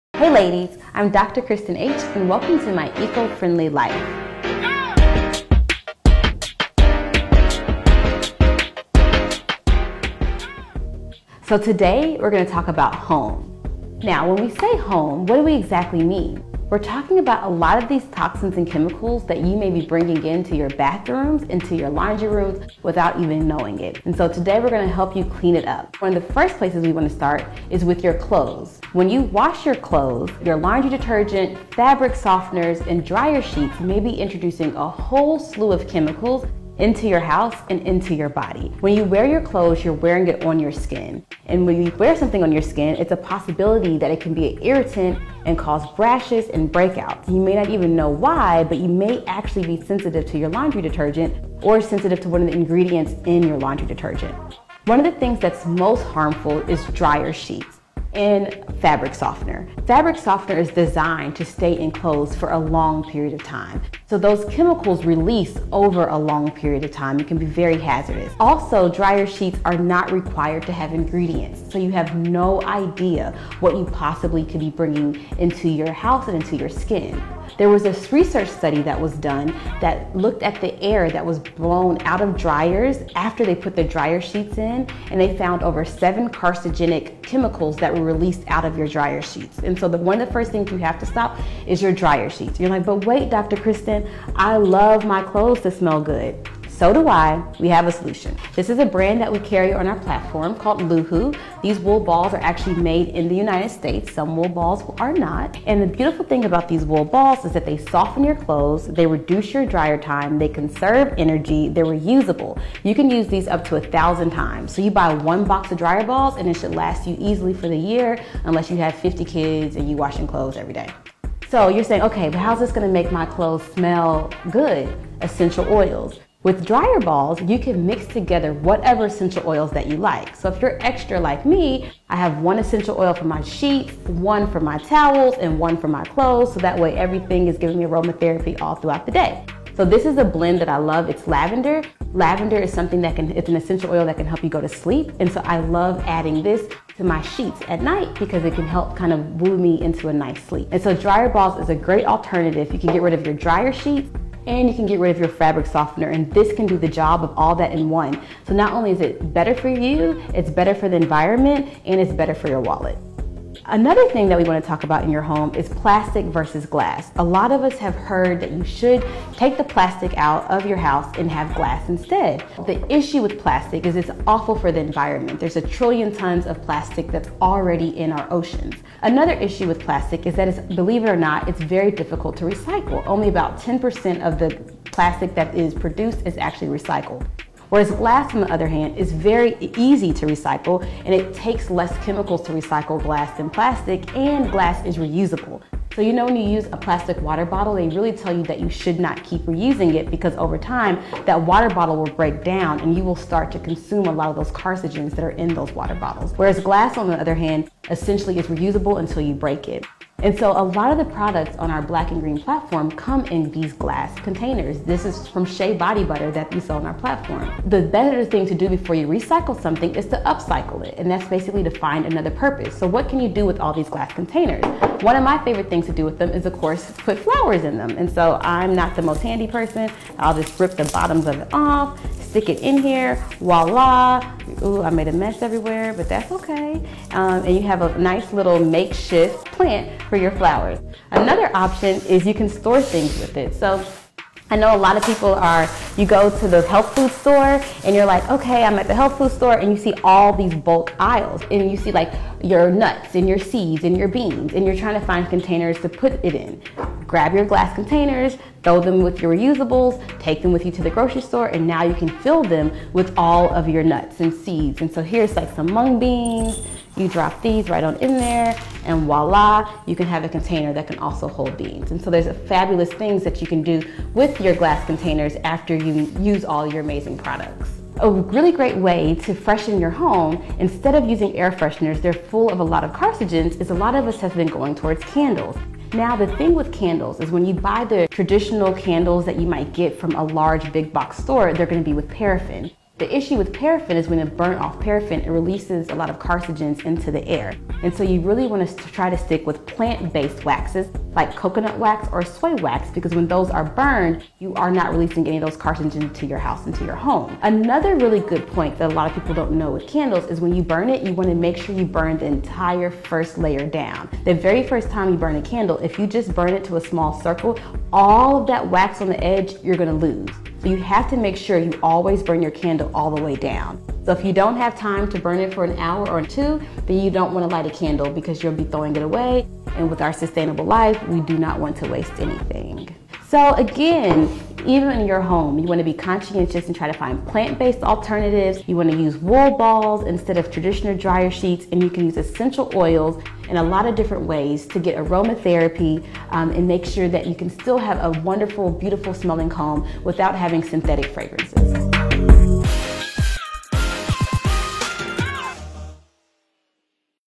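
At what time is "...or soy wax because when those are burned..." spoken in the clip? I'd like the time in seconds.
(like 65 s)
302 s.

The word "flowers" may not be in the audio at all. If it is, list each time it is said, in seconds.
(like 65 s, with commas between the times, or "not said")
227 s, 240 s.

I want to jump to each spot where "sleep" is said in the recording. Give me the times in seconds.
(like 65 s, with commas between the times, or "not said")
144 s, 150 s.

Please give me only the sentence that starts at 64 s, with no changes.
So those chemicals release over a long period of time.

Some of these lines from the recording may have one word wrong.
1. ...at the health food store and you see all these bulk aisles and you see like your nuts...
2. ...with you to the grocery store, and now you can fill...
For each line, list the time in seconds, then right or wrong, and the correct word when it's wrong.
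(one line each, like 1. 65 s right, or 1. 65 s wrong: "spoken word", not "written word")
1. 248 s right
2. 260 s right.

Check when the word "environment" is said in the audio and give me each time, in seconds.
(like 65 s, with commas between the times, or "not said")
160 s, 174 s.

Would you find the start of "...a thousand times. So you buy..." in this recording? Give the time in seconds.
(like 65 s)
113 s.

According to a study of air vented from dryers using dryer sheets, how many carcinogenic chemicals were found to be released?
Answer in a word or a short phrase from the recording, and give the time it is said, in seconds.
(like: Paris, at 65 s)
over 7, at 85 s.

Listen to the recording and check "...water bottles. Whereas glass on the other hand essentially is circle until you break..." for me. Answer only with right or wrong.
wrong.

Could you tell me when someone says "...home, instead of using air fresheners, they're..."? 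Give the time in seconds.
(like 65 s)
279 s.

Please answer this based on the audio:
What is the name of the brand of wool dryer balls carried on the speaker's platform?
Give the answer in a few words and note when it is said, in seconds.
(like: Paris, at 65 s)
LooHoo, at 100 s.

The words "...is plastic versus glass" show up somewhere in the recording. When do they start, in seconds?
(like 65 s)
165 s.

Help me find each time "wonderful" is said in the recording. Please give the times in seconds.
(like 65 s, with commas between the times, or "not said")
348 s.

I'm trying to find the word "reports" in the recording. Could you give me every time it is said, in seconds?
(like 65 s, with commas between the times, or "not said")
not said.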